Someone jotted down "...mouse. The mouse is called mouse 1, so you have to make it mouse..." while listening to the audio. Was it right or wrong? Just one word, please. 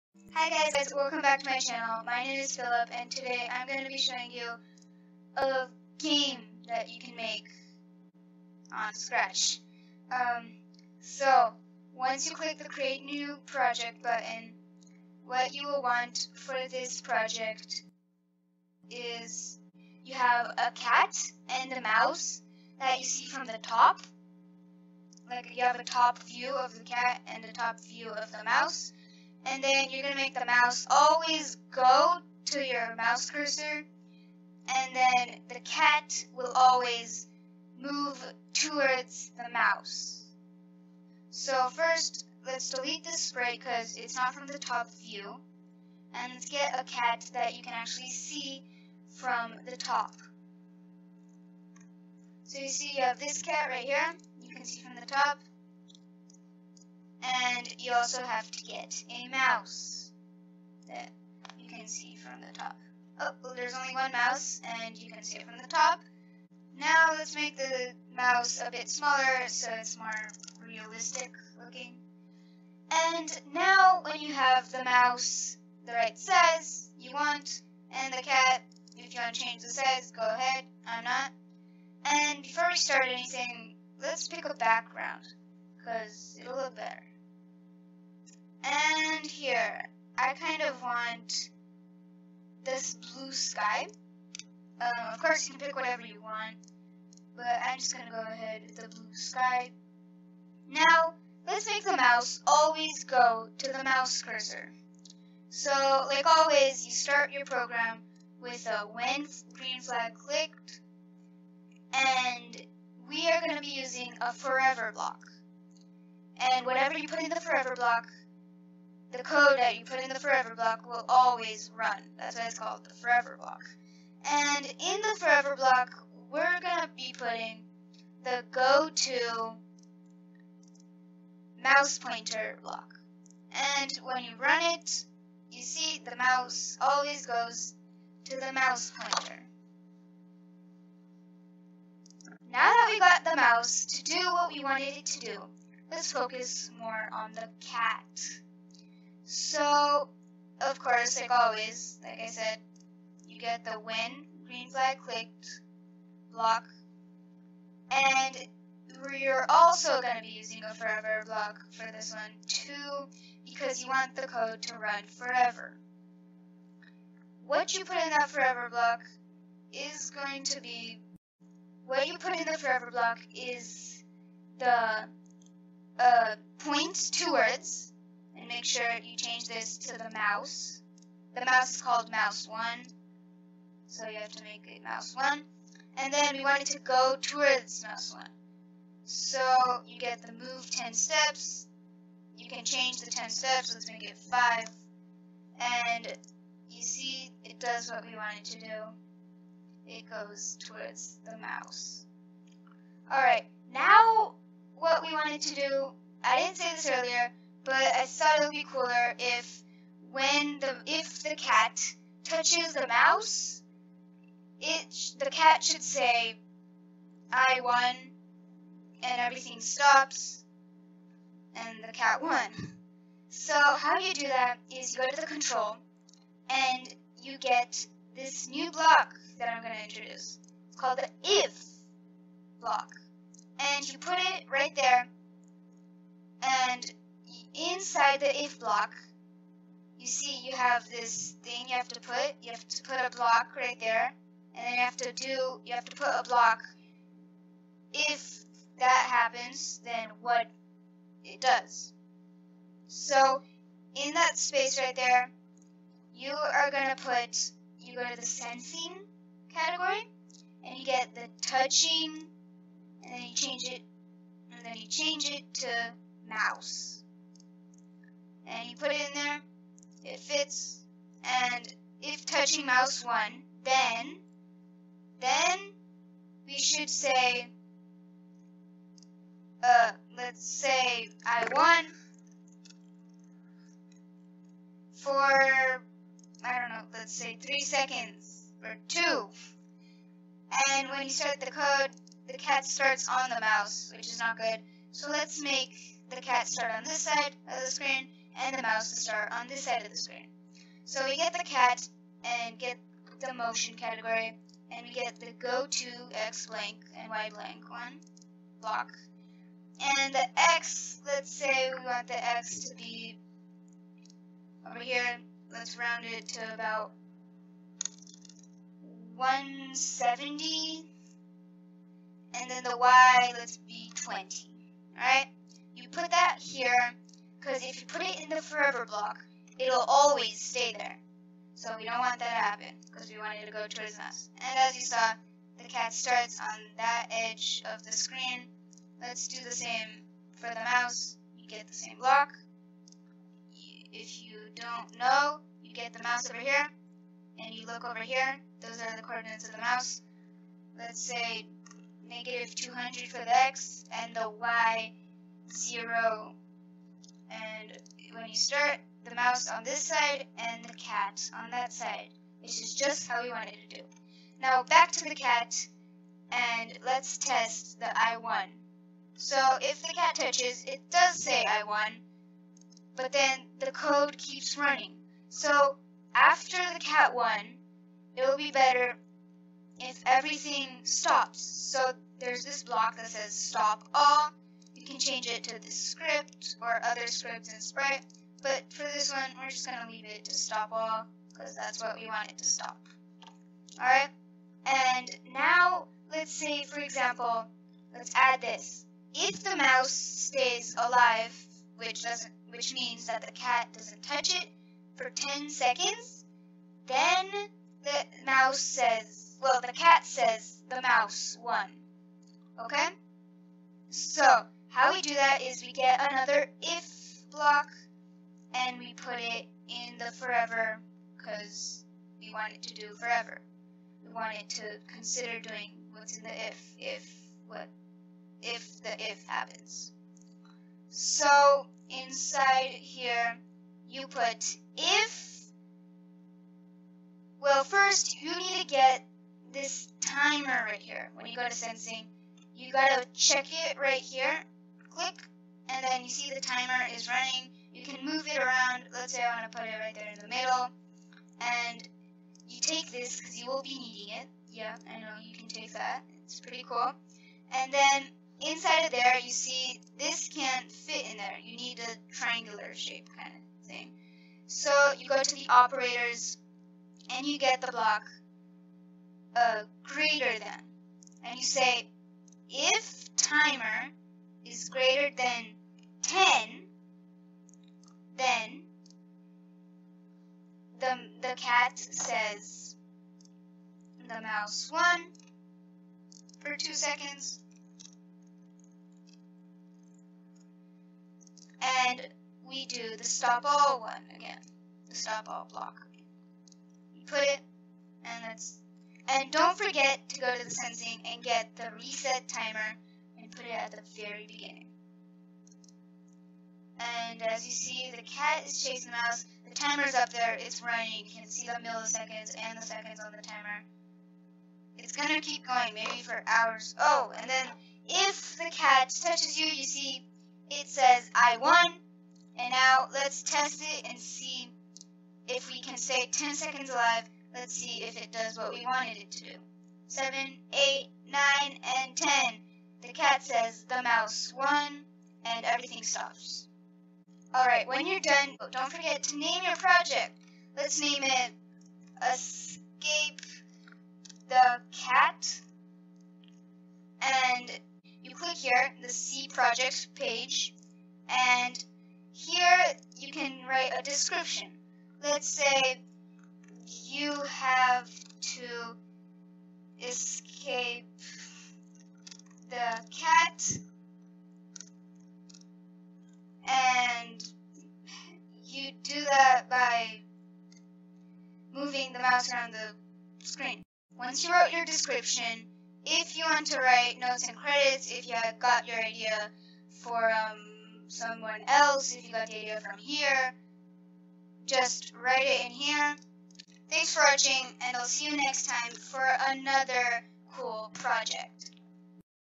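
right.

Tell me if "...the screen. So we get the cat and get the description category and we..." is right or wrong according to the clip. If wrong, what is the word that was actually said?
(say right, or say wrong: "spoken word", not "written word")
wrong: "motion", not "description".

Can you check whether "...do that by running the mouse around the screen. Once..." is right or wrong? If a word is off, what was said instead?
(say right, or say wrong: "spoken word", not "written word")
wrong: "moving", not "running".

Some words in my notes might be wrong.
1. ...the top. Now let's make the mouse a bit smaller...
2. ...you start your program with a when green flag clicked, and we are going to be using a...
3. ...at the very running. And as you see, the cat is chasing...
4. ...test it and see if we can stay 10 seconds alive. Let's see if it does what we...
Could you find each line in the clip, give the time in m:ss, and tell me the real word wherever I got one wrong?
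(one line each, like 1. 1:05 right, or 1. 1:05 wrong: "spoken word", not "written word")
1. 1:05 right
2. 1:46 right
3. 8:23 wrong: "beginning", not "running"
4. 8:43 right.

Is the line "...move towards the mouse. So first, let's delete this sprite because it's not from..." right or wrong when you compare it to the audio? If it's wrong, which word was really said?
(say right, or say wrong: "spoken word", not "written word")
right.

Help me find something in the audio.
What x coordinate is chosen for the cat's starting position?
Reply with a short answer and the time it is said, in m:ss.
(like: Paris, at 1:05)
170, at 5:19.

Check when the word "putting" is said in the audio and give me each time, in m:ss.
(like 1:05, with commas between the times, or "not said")
2:07.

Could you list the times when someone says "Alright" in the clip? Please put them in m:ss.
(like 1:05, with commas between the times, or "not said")
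3:23, 6:33, 8:57.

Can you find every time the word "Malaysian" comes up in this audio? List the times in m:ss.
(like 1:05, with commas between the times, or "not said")
not said.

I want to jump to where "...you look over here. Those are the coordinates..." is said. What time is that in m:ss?
5:47.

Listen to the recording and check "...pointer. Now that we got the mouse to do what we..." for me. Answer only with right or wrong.
right.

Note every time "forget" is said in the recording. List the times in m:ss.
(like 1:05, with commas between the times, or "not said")
8:19, 8:58.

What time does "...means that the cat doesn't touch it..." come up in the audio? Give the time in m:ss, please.
6:42.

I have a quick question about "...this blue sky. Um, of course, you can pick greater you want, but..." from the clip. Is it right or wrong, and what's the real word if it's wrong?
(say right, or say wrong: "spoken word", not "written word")
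wrong: "whatever", not "greater".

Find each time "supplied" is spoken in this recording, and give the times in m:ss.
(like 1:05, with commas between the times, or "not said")
not said.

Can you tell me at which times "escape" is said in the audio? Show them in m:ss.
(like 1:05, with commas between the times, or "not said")
9:02, 9:19.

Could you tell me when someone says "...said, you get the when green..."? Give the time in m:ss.
2:32.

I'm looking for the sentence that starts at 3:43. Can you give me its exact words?
So how you do that is you go to the control, and you get this new block that I'm going to introduce.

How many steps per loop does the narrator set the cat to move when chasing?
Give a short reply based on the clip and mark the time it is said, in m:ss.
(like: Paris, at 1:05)
5, at 3:13.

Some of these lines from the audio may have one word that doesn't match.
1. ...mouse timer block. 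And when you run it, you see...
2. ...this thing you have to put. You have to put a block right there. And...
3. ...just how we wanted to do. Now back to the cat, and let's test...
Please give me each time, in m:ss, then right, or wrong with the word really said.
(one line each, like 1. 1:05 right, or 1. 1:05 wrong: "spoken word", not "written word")
1. 2:11 wrong: "pointer", not "timer"
2. 4:00 right
3. 6:02 right.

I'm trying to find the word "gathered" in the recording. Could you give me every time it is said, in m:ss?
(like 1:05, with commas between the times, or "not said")
not said.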